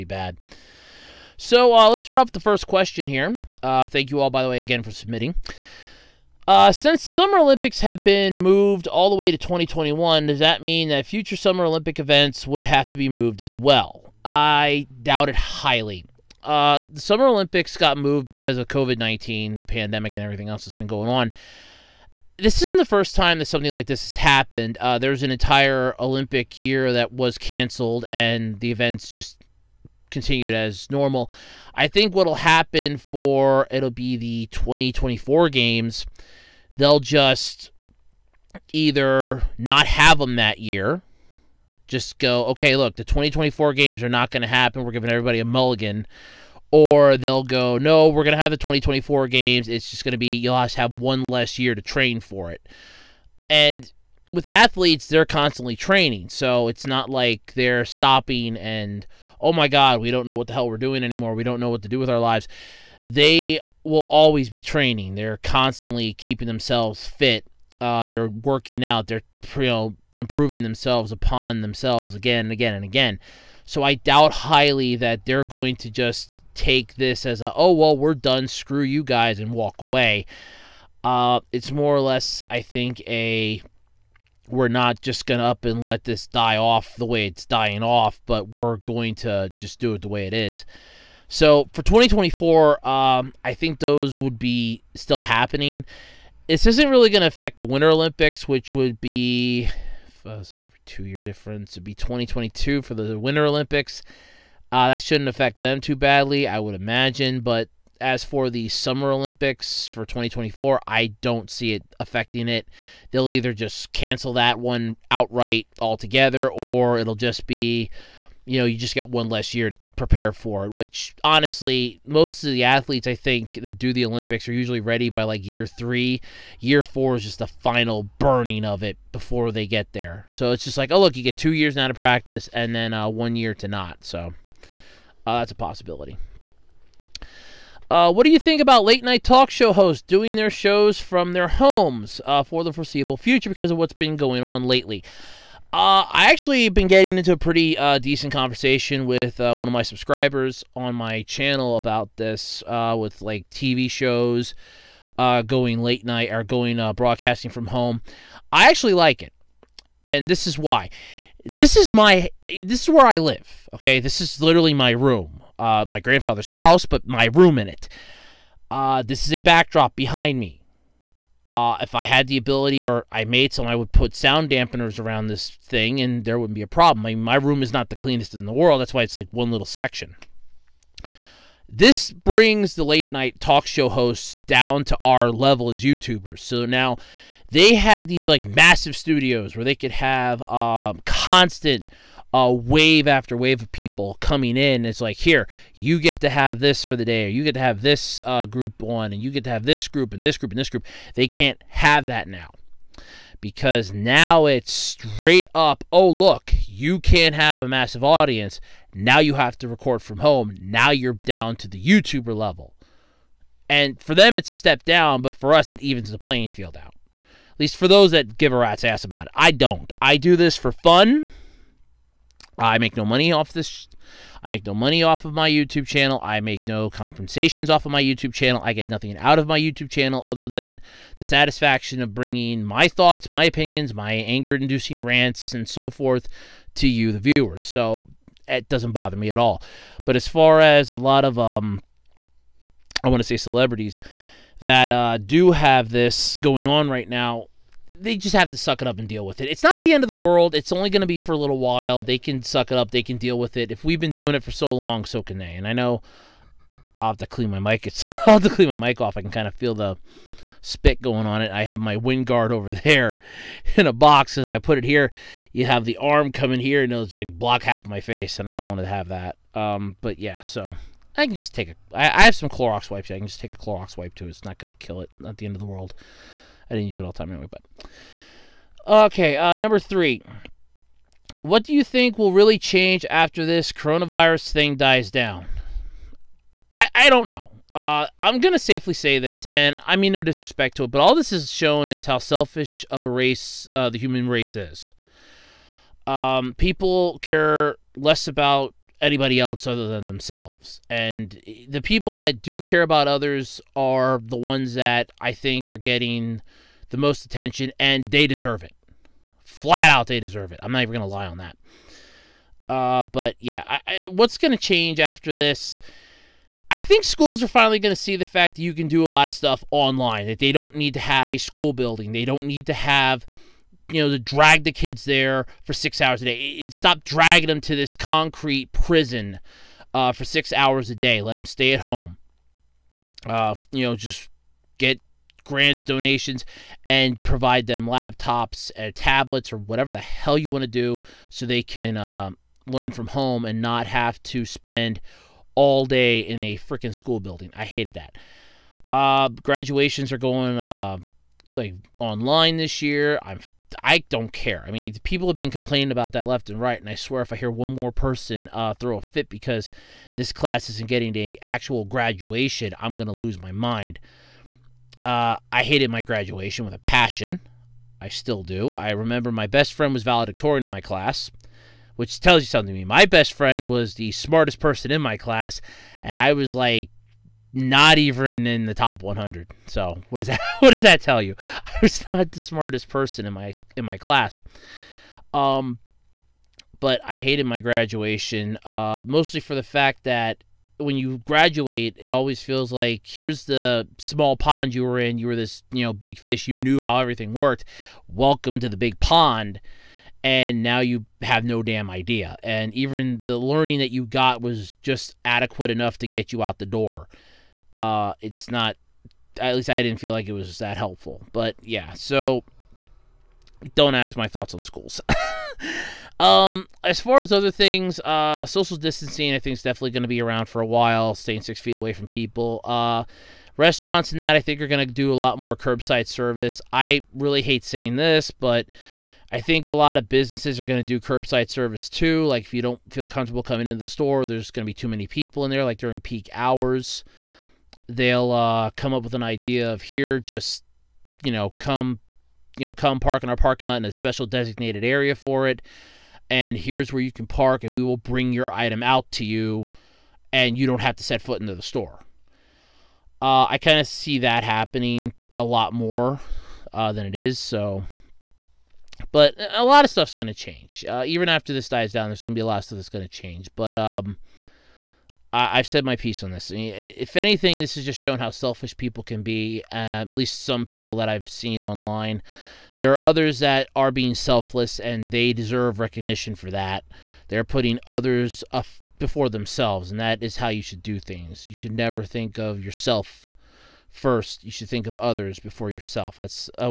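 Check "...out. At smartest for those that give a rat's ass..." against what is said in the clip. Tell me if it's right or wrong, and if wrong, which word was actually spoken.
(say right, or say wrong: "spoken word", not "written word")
wrong: "least", not "smartest".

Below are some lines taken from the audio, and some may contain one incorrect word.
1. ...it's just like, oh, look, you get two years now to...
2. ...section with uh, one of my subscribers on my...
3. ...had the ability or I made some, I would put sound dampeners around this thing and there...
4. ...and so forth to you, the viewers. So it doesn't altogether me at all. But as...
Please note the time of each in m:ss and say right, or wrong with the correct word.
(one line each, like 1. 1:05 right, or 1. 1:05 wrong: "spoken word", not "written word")
1. 2:10 right
2. 2:28 wrong: "conversation", not "section"
3. 2:52 right
4. 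3:55 wrong: "bother", not "altogether".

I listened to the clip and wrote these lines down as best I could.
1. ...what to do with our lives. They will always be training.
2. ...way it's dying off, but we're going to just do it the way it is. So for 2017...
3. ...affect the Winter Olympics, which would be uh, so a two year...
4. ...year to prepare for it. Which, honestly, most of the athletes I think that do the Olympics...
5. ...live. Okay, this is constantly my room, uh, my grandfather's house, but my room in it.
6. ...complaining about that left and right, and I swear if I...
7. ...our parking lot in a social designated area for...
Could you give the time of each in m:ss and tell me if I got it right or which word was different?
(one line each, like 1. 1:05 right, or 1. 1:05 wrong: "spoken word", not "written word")
1. 1:01 right
2. 1:27 wrong: "2024", not "2017"
3. 1:37 right
4. 1:59 right
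5. 2:43 wrong: "literally", not "constantly"
6. 5:55 right
7. 7:23 wrong: "special", not "social".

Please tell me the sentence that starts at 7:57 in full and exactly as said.
They're putting others up before themselves, and that is how you should do things.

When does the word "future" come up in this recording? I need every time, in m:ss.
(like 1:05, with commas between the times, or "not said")
0:11, 2:23.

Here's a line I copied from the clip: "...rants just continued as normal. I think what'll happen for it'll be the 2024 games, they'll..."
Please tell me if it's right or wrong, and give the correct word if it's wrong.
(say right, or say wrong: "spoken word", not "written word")
wrong: "events", not "rants".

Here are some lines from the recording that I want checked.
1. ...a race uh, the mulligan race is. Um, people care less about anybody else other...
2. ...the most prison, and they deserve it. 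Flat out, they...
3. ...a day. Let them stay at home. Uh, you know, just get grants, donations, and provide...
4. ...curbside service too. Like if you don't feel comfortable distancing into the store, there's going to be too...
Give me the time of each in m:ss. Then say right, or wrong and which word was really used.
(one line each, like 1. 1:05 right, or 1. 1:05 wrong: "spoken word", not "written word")
1. 4:53 wrong: "human", not "mulligan"
2. 5:06 wrong: "attention", not "prison"
3. 5:30 right
4. 7:10 wrong: "coming", not "distancing".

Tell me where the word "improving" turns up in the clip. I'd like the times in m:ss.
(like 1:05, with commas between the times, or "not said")
1:10.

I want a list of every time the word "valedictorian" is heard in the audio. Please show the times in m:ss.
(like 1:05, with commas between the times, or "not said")
6:10.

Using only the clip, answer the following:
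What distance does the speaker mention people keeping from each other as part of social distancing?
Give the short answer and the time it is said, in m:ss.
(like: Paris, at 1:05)
6 feet, at 7:01.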